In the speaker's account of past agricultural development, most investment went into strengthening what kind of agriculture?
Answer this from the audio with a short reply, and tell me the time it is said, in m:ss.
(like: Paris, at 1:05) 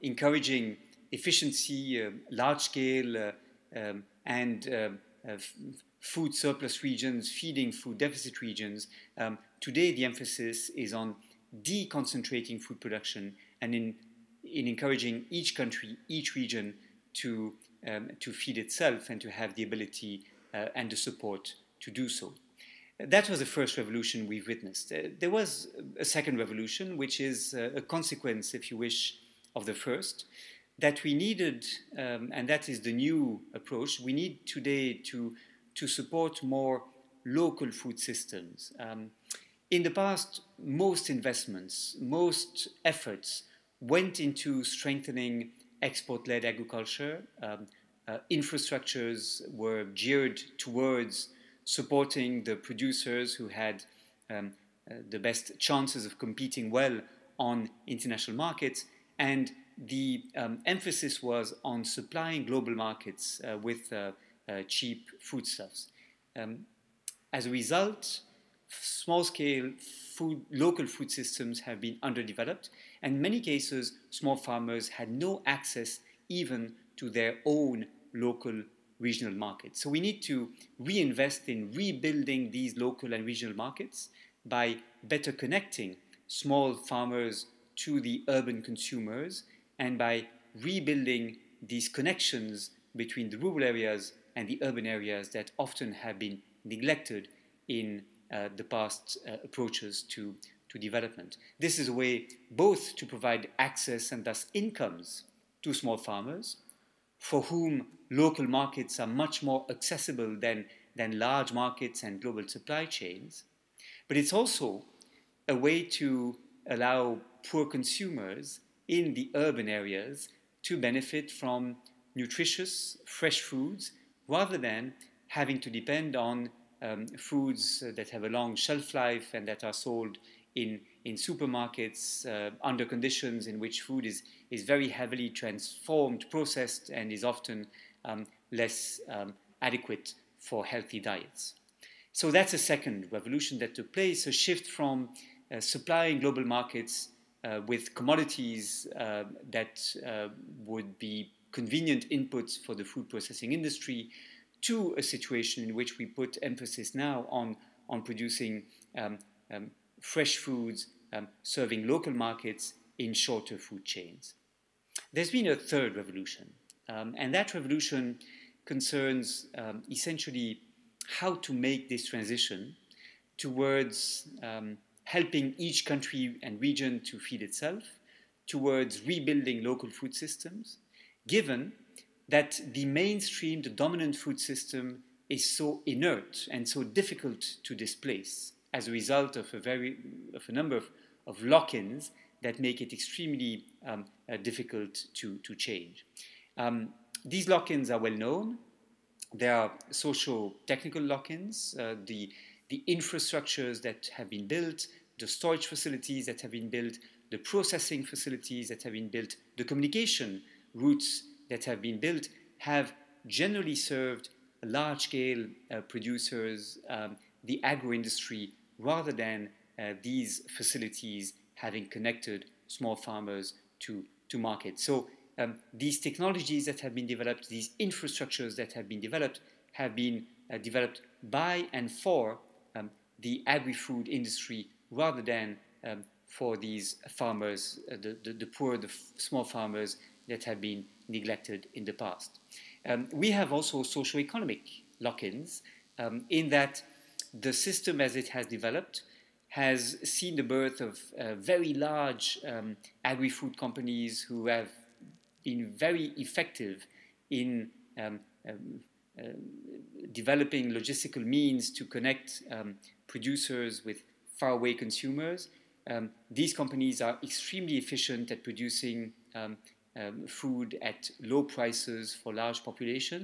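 Export led agriculture, at 0:45.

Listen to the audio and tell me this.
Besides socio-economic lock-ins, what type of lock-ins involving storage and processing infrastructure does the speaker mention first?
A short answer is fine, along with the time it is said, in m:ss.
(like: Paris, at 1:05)
Social technical lock-ins, at 3:19.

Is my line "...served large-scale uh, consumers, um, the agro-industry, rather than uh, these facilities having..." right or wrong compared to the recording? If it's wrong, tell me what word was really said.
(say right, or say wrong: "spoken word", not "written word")
wrong: "producers", not "consumers".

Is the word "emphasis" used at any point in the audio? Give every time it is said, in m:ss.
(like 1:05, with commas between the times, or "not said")
0:10, 1:00, 2:36.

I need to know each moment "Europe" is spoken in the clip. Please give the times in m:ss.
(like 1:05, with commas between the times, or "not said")
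not said.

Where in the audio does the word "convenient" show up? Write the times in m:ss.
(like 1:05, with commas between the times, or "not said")
2:31.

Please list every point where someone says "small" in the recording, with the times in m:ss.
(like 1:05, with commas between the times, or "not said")
1:08, 1:14, 1:26, 1:45, 3:42, 3:59.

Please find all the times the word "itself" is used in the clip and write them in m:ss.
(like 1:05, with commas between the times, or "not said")
0:18, 2:57.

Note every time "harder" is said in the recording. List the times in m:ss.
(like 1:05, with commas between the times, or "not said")
not said.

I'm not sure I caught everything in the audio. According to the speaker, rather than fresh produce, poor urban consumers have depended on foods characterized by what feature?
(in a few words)
Long shelf life.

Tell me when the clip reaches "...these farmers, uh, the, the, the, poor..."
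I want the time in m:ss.
3:56.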